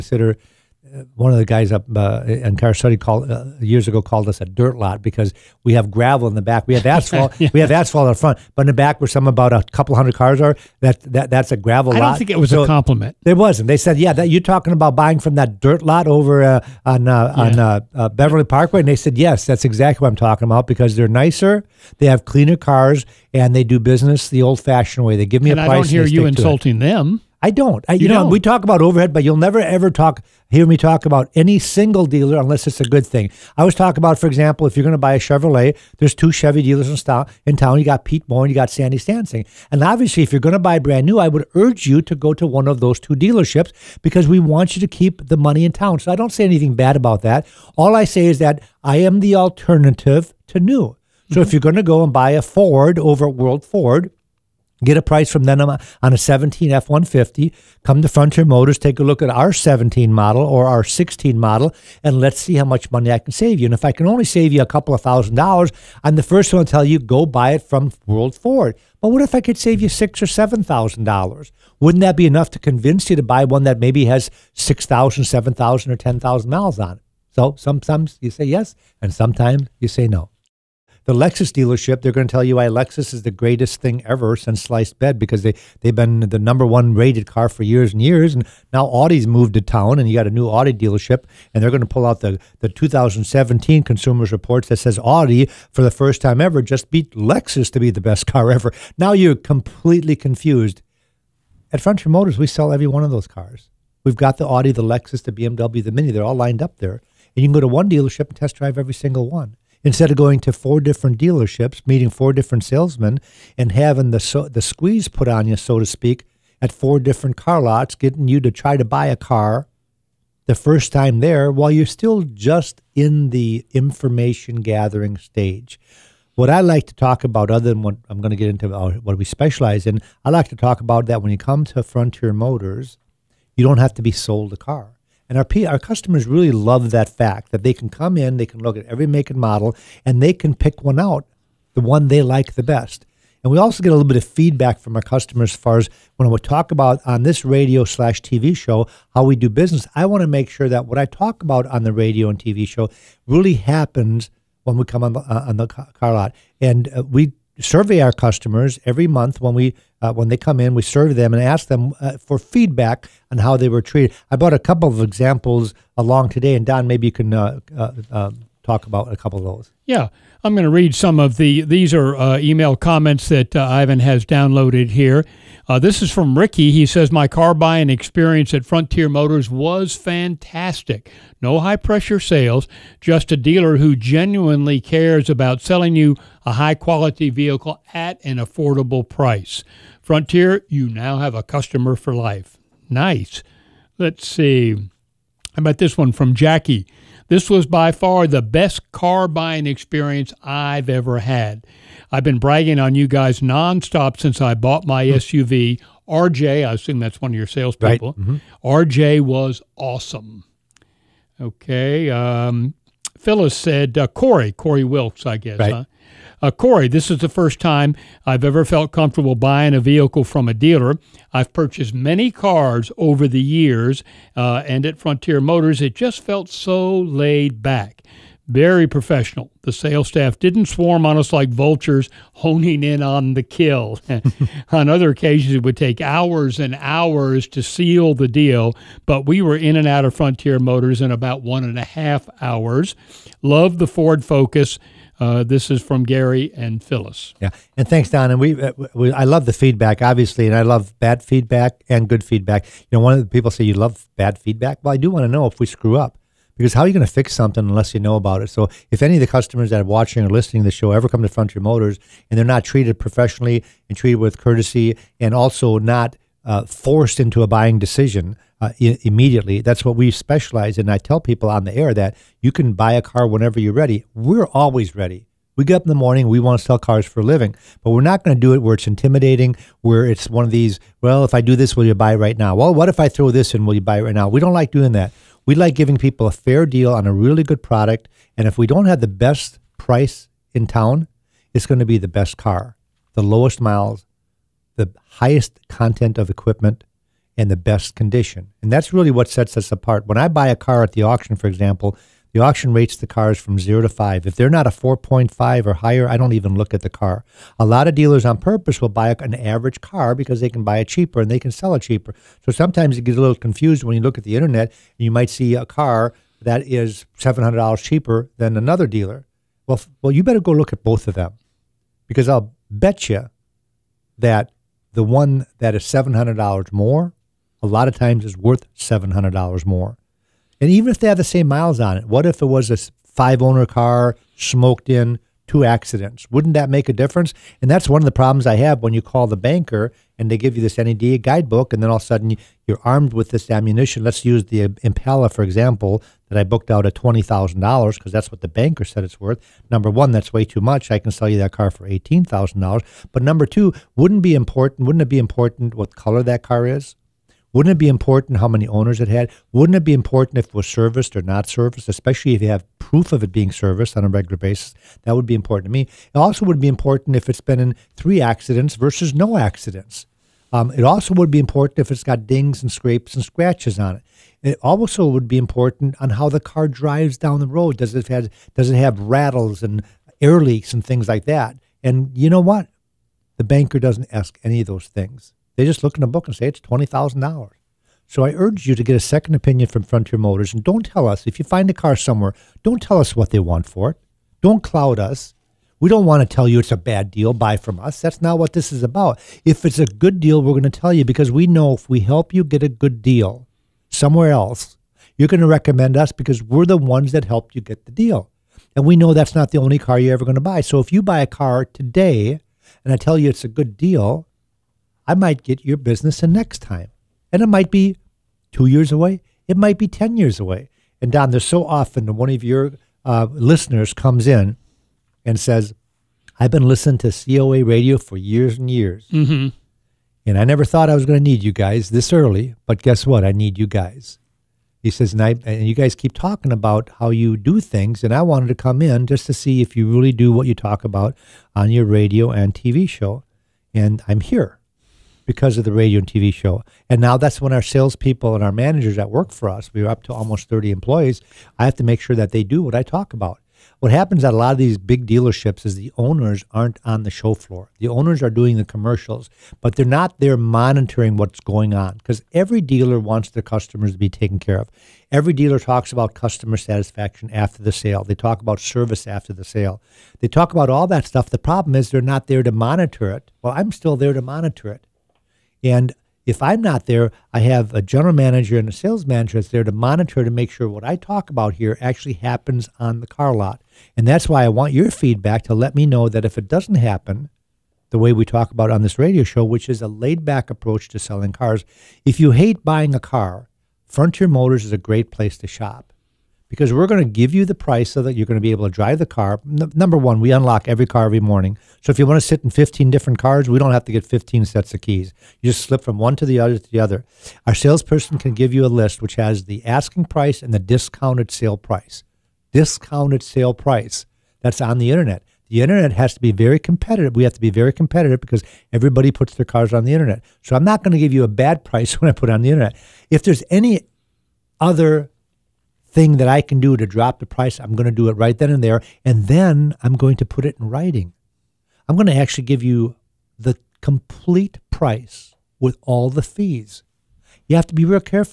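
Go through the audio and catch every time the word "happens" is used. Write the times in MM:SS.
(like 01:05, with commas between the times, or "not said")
02:33, 07:33, 08:02, 08:06.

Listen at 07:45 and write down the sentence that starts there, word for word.
Every dealer talks about customer satisfaction after the sale.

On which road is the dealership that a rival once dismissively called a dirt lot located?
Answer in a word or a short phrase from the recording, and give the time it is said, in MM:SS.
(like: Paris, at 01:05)
Beverly Parkway, at 00:18.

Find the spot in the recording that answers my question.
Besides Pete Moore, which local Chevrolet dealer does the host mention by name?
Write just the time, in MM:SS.
00:38.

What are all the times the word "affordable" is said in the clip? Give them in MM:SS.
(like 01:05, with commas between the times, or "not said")
03:08.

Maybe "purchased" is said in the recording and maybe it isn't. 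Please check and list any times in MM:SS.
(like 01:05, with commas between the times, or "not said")
03:41.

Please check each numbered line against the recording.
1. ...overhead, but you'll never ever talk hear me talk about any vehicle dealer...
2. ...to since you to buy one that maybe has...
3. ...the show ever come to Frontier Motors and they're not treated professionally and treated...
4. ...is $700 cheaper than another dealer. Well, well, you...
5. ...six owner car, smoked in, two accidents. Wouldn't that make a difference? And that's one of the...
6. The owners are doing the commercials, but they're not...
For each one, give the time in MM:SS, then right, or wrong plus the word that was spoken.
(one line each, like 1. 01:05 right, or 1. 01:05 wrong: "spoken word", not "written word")
1. 00:28 wrong: "single", not "vehicle"
2. 01:12 wrong: "convince", not "since"
3. 04:20 right
4. 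05:16 right
5. 05:33 wrong: "five", not "six"
6. 07:37 right.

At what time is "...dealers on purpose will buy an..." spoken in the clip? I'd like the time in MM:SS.
05:07.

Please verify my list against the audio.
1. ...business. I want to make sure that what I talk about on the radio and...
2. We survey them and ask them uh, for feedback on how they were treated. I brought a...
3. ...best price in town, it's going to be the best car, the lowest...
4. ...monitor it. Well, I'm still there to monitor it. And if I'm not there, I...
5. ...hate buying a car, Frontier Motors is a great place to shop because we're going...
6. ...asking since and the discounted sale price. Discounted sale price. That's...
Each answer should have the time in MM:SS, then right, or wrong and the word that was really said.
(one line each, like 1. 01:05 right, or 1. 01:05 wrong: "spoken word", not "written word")
1. 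02:29 right
2. 02:40 right
3. 04:49 right
4. 07:52 right
5. 08:12 right
6. 08:29 wrong: "price", not "since".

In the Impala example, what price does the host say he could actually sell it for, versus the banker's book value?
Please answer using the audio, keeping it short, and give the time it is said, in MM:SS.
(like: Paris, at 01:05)
$18,000, at 05:51.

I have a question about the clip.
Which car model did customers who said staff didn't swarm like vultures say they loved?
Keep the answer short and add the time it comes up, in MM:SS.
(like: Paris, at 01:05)
Ford Focus, at 04:03.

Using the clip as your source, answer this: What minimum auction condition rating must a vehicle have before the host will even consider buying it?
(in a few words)
4.5.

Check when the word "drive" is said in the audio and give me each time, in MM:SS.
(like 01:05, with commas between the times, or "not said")
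01:48, 06:16, 08:18.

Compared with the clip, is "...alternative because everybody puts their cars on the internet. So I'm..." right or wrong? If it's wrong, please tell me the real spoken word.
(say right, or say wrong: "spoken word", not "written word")
wrong: "competitive", not "alternative".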